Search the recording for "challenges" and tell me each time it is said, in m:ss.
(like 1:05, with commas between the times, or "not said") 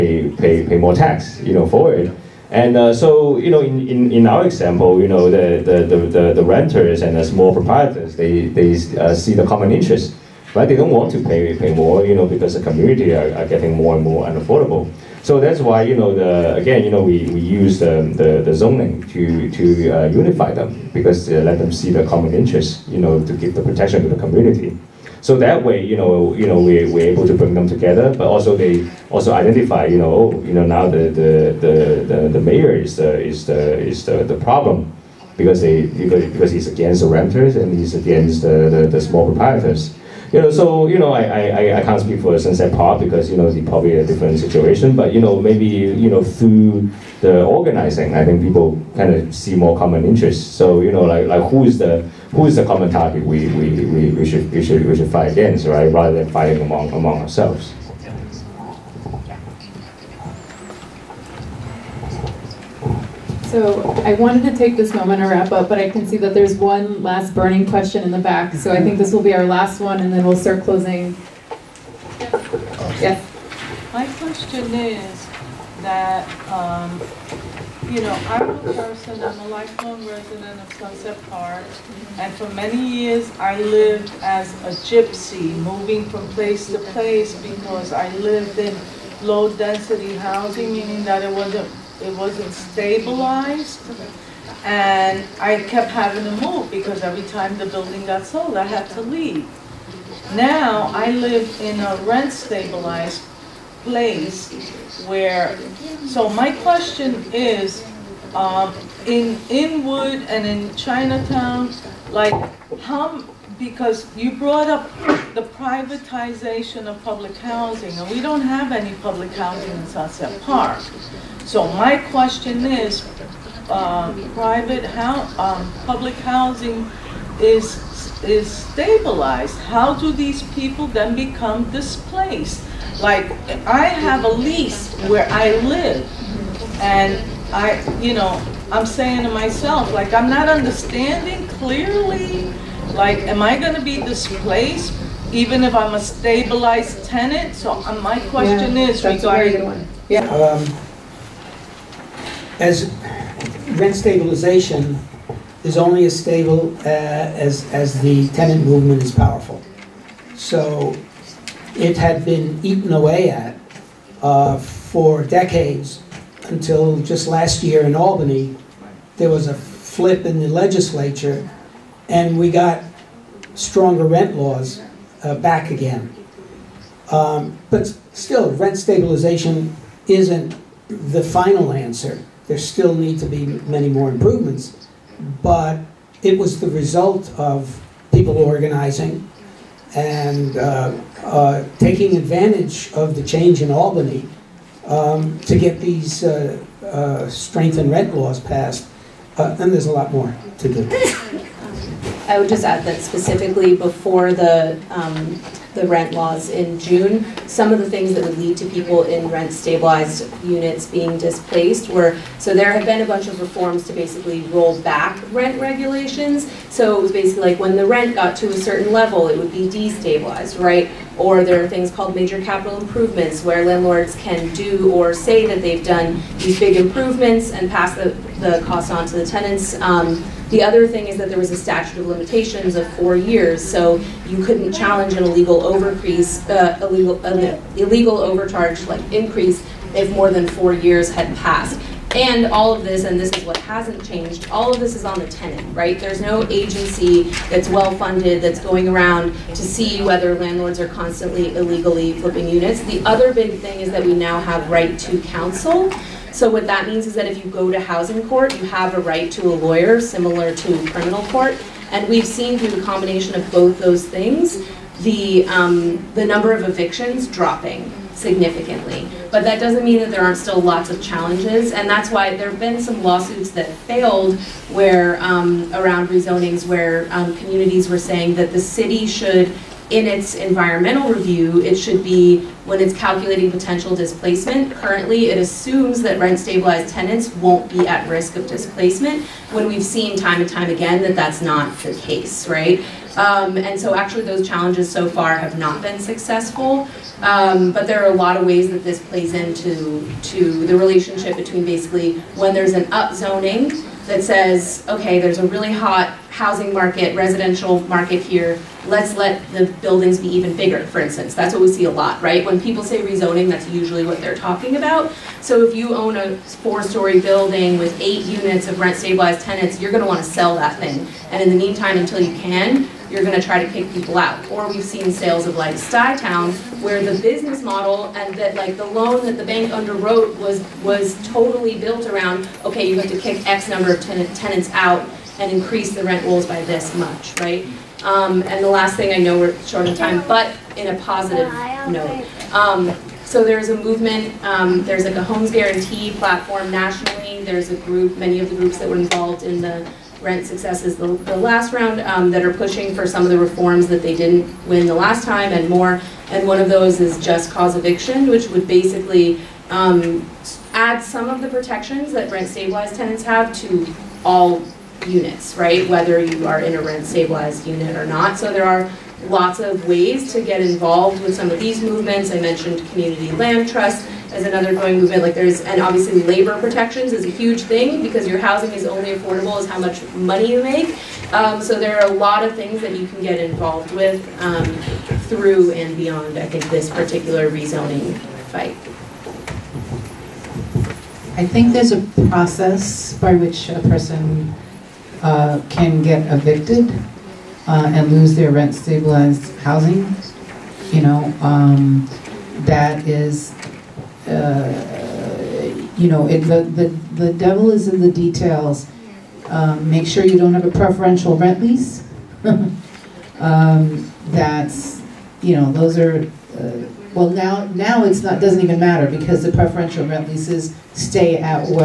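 3:54, 4:31, 4:54.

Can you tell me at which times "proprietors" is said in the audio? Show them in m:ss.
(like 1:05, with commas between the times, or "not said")
0:07, 0:39.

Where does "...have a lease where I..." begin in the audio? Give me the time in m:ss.
2:13.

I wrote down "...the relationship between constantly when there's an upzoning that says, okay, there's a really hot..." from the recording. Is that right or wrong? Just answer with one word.
wrong.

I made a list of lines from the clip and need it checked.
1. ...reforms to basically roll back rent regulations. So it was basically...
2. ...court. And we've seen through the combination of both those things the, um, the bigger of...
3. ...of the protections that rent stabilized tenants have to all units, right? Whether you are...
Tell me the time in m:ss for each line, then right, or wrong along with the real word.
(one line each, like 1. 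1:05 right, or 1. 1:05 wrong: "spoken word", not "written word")
1. 3:33 right
2. 4:21 wrong: "number", not "bigger"
3. 6:01 right.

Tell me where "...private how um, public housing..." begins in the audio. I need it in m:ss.
2:04.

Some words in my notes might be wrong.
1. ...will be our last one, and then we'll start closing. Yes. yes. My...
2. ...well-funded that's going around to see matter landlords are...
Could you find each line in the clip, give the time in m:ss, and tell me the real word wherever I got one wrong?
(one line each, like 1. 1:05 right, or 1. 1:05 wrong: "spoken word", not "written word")
1. 1:09 right
2. 4:07 wrong: "whether", not "matter".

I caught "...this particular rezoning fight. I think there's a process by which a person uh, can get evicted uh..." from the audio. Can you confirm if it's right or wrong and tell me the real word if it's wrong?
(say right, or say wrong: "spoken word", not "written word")
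right.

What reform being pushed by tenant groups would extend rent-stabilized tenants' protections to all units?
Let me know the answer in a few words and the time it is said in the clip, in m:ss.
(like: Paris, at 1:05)
just cause eviction, at 5:57.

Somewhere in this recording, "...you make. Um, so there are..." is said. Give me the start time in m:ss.
6:20.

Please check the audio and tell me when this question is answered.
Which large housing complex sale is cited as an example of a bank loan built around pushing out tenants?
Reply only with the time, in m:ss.
5:25.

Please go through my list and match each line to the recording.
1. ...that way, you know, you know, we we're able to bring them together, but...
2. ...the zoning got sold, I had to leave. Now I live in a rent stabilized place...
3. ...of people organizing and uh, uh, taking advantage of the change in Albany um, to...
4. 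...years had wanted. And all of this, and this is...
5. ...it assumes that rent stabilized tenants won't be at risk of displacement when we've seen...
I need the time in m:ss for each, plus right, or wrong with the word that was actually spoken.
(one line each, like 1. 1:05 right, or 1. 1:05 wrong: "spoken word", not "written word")
1. 0:25 right
2. 1:37 wrong: "building", not "zoning"
3. 3:07 right
4. 4:00 wrong: "passed", not "wanted"
5. 4:45 right.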